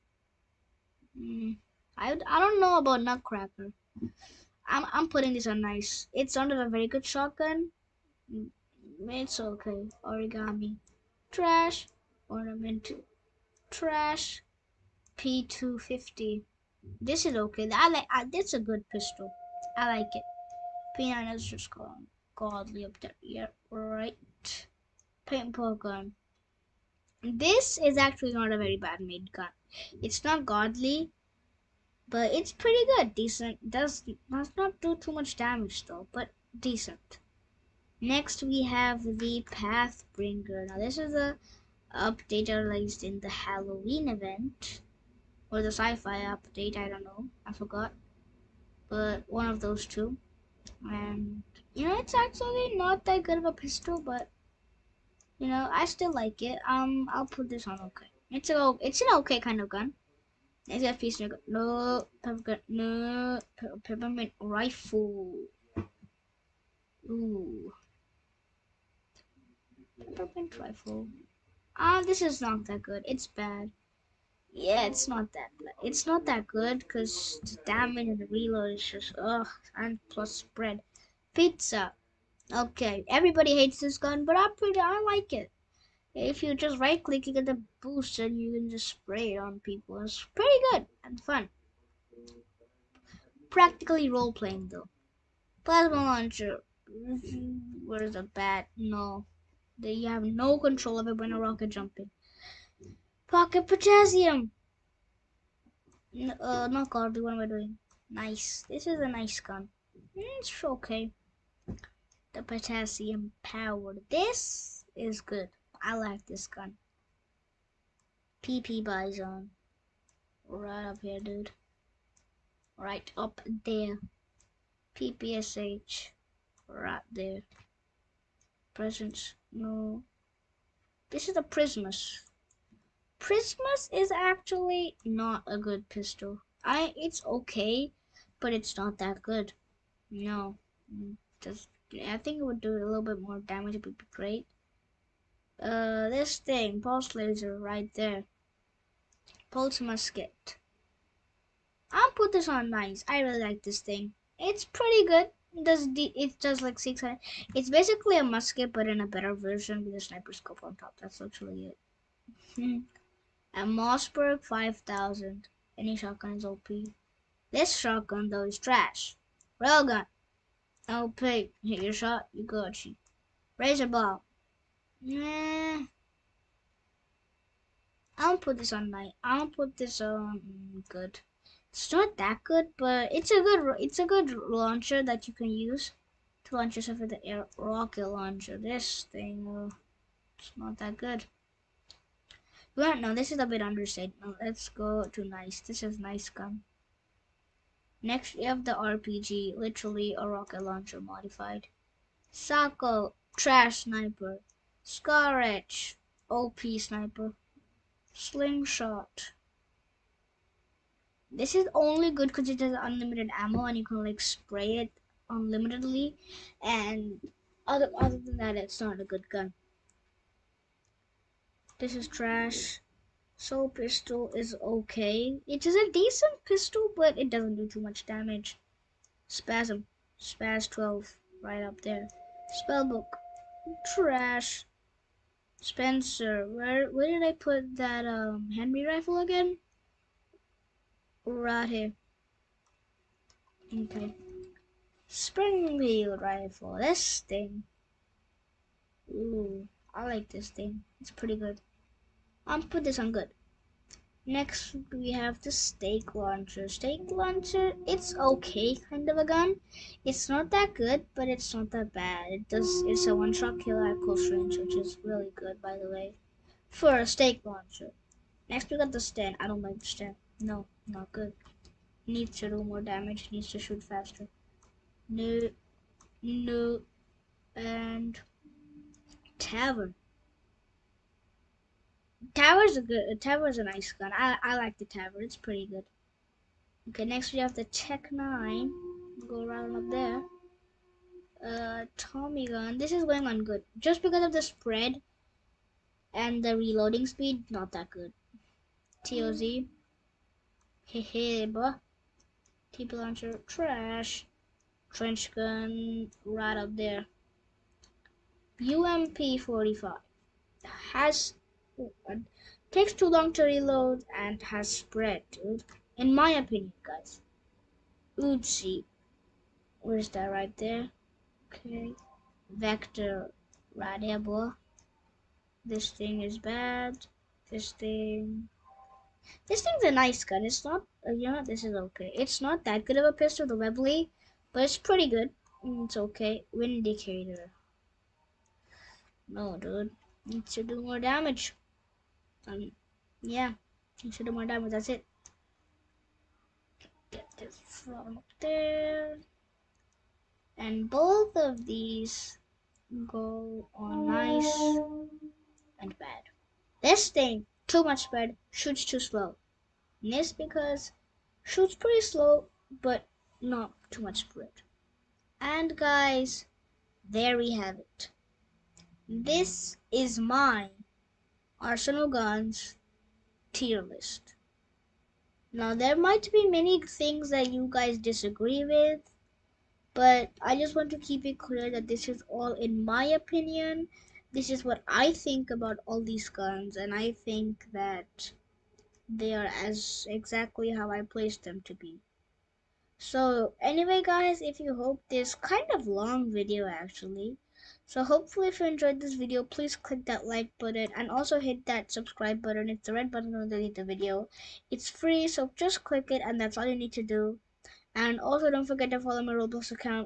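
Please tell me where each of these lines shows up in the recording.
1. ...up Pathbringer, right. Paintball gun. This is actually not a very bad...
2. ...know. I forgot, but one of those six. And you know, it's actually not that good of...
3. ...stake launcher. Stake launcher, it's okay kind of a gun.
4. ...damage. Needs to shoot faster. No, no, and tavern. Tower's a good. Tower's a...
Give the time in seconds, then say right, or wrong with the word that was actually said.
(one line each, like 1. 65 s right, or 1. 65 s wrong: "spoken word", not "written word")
1. 22 s wrong: "Yeah", not "Pathbringer"
2. 47 s wrong: "two", not "six"
3. 255 s right
4. 272 s right.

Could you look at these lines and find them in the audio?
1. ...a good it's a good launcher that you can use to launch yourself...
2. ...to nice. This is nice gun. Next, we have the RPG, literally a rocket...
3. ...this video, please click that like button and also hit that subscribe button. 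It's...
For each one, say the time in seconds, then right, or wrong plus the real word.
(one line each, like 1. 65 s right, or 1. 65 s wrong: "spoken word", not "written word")
1. 183 s right
2. 195 s right
3. 399 s right.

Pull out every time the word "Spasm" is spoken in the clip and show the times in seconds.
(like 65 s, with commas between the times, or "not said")
229 s.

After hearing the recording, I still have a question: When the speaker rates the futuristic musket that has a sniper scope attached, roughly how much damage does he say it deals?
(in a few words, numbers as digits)
600.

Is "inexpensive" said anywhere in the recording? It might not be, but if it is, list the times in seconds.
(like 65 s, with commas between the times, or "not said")
not said.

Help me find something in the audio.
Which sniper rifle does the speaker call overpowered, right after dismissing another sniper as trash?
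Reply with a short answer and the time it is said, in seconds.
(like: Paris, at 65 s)
Scarage, at 204 s.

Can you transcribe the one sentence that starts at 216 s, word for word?
And other, other than that, it's not a good gun.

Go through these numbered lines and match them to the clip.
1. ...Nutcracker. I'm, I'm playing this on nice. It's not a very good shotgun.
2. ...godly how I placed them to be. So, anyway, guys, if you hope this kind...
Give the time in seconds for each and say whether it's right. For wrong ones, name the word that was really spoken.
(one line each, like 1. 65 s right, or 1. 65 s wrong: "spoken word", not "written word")
1. 3 s wrong: "putting", not "playing"
2. 390 s wrong: "exactly", not "godly".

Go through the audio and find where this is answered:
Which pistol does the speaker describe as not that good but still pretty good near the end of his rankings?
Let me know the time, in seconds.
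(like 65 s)
333 s.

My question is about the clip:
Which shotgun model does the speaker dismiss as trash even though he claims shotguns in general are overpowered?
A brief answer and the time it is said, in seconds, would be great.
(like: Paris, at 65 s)
Mossberg 5000, at 163 s.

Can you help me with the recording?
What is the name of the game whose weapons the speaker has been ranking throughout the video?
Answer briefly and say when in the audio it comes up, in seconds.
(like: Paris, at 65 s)
Arsenal, at 371 s.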